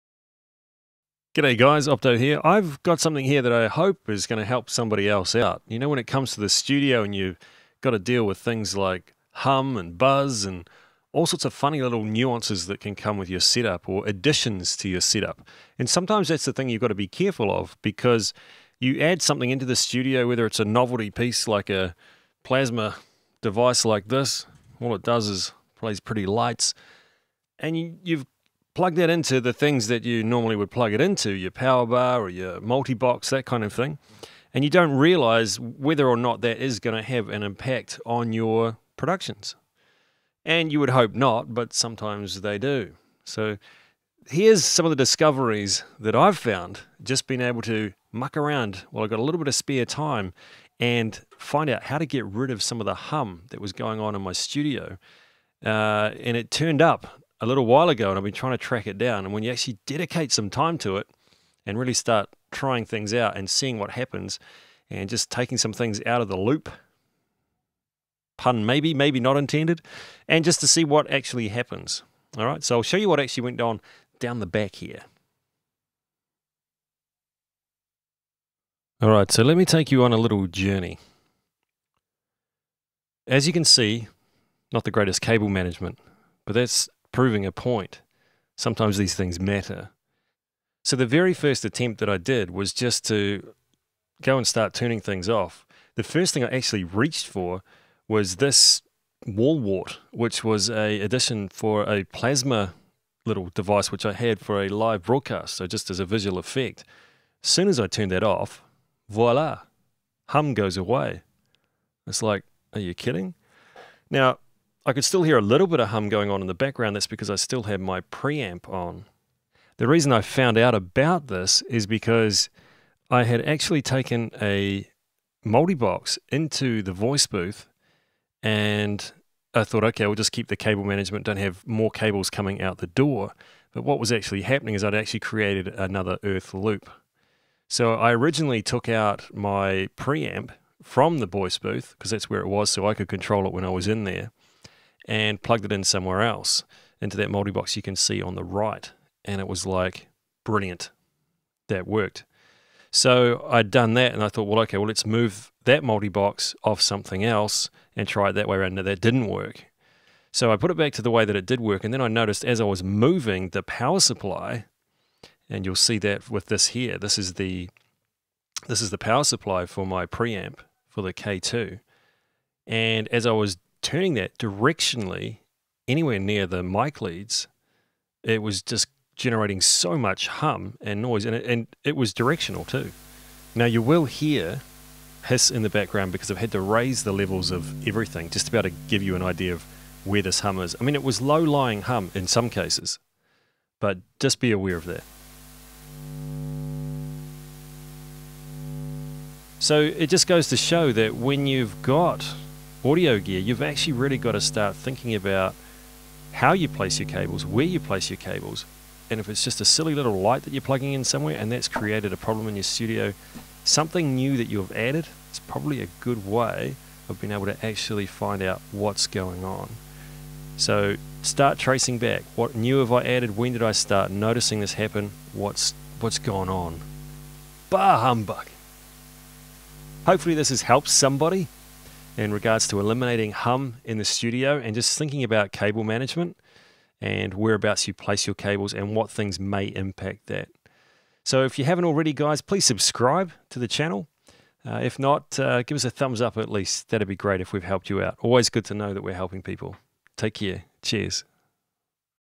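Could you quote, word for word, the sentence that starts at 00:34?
And you don't realize whether or not that is going to have an impact on your productions.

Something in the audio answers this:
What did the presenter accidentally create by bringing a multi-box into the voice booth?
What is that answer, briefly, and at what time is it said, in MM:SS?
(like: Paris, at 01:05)
earth loop, at 02:16.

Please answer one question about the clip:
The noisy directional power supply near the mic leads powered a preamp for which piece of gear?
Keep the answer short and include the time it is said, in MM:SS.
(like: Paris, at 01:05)
K2, at 02:51.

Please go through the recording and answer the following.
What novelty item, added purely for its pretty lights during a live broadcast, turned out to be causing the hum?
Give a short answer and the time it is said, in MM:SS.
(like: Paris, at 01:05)
plasma device, at 00:22.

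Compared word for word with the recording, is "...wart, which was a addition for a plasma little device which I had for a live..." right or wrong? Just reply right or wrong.
right.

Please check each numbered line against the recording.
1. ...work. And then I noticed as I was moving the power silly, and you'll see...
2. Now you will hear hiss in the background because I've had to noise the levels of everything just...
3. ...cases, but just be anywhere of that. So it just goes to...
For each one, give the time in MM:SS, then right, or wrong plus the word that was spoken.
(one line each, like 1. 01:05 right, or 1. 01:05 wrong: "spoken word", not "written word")
1. 02:41 wrong: "supply", not "silly"
2. 03:03 wrong: "raise", not "noise"
3. 03:12 wrong: "aware", not "anywhere".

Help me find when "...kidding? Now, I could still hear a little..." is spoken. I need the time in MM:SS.
01:52.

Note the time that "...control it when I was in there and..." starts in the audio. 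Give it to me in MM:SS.
02:23.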